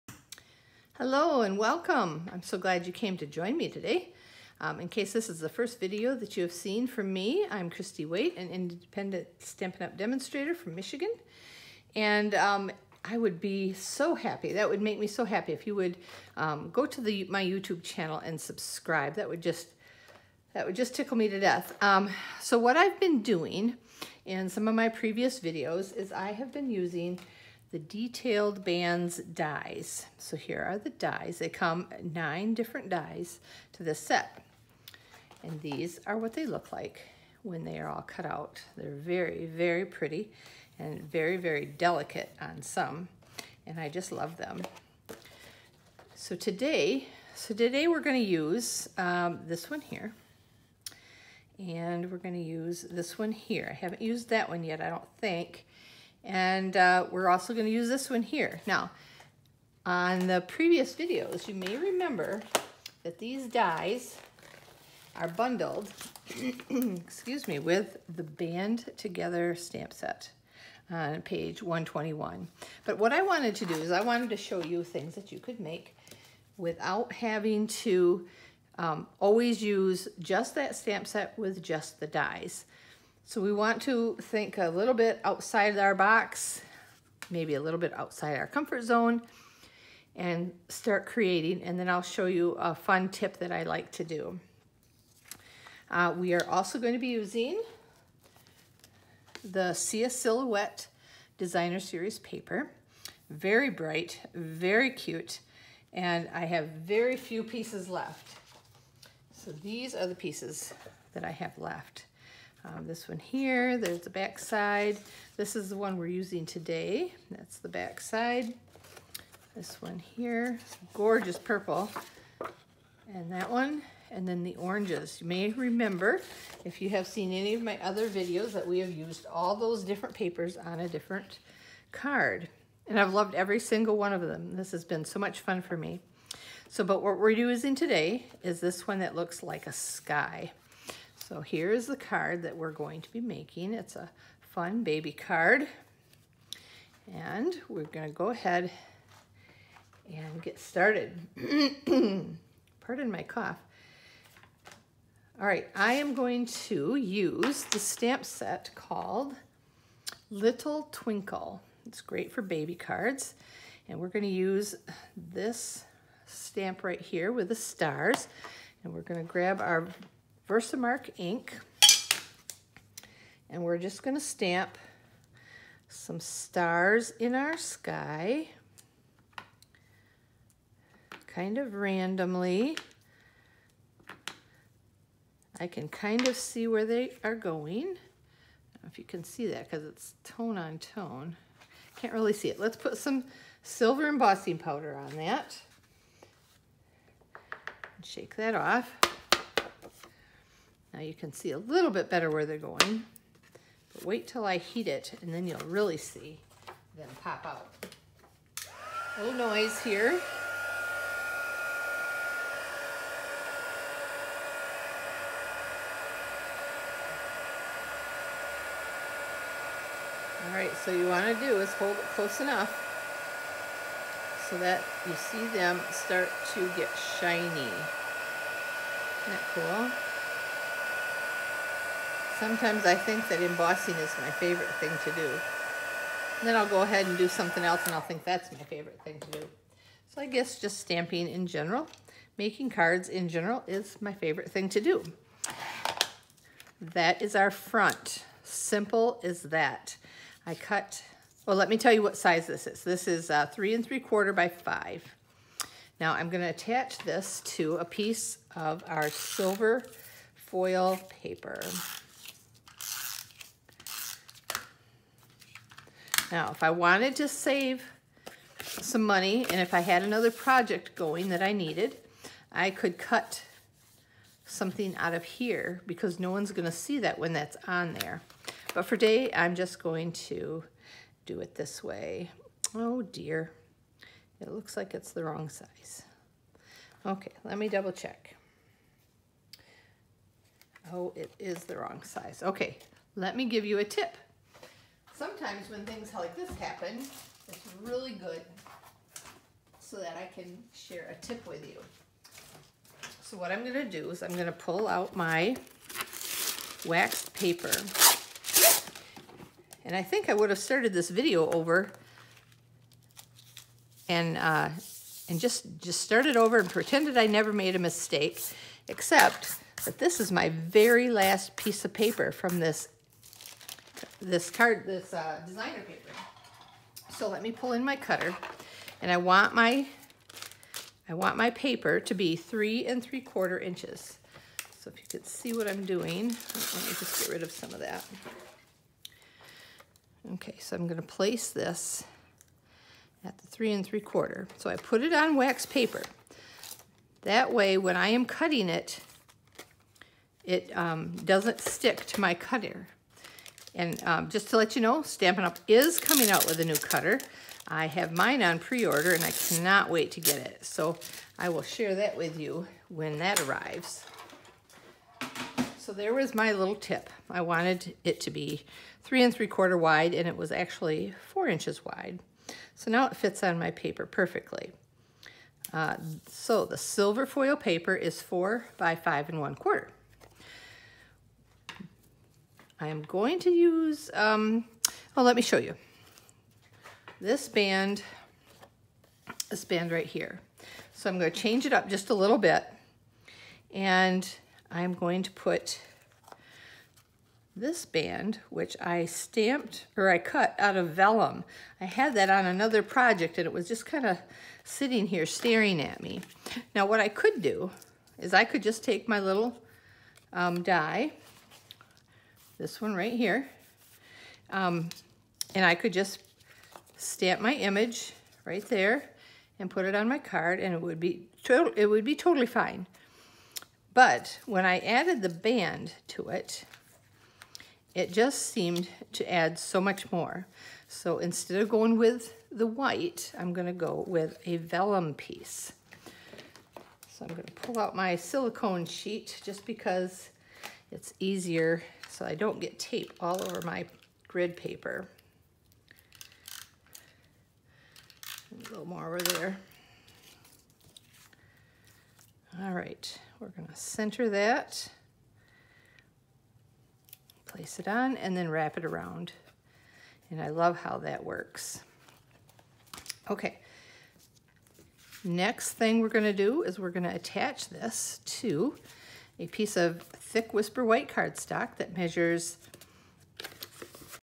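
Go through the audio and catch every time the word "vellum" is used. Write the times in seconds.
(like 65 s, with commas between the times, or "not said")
400 s, 434 s.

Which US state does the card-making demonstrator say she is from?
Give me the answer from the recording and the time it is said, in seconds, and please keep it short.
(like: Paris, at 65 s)
Michigan, at 10 s.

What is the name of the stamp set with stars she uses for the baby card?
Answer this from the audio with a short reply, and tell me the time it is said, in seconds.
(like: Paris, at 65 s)
Little Twinkle, at 160 s.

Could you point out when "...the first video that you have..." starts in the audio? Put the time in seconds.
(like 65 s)
5 s.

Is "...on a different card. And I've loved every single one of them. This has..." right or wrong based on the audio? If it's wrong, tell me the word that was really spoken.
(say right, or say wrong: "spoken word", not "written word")
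right.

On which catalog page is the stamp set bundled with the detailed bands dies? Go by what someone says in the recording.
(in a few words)
121.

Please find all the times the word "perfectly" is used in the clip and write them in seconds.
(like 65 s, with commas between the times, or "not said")
374 s.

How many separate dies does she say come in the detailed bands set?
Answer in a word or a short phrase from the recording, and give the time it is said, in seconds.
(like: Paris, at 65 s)
9, at 32 s.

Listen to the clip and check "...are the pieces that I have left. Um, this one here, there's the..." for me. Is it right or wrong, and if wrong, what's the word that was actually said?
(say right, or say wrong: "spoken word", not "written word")
right.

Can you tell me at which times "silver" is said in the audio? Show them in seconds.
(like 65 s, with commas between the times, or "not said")
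193 s, 259 s, 376 s.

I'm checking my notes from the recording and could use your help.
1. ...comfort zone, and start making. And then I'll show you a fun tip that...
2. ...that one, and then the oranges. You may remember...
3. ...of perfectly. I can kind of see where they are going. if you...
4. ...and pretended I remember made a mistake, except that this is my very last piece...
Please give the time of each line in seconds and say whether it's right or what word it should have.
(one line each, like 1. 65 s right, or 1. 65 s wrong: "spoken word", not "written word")
1. 88 s wrong: "creating", not "making"
2. 123 s right
3. 181 s wrong: "randomly", not "perfectly"
4. 316 s wrong: "never", not "remember".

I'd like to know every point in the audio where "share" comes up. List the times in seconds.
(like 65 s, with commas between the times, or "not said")
300 s, 361 s.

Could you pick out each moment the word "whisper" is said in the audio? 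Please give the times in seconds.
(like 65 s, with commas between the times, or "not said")
470 s.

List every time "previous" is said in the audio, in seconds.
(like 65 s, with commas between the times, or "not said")
24 s, 60 s.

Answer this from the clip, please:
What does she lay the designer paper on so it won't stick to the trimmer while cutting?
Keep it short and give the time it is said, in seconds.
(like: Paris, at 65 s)
Waxed paper, at 306 s.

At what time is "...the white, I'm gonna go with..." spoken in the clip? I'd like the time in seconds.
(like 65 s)
432 s.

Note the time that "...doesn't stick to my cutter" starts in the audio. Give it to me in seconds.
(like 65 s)
351 s.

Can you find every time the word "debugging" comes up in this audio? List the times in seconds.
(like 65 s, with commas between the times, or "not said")
not said.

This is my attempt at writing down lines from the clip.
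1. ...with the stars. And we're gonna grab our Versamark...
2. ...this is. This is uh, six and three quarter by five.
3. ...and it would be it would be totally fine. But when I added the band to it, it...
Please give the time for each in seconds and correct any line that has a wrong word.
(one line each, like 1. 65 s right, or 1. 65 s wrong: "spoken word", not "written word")
1. 167 s right
2. 252 s wrong: "three", not "six"
3. 420 s right.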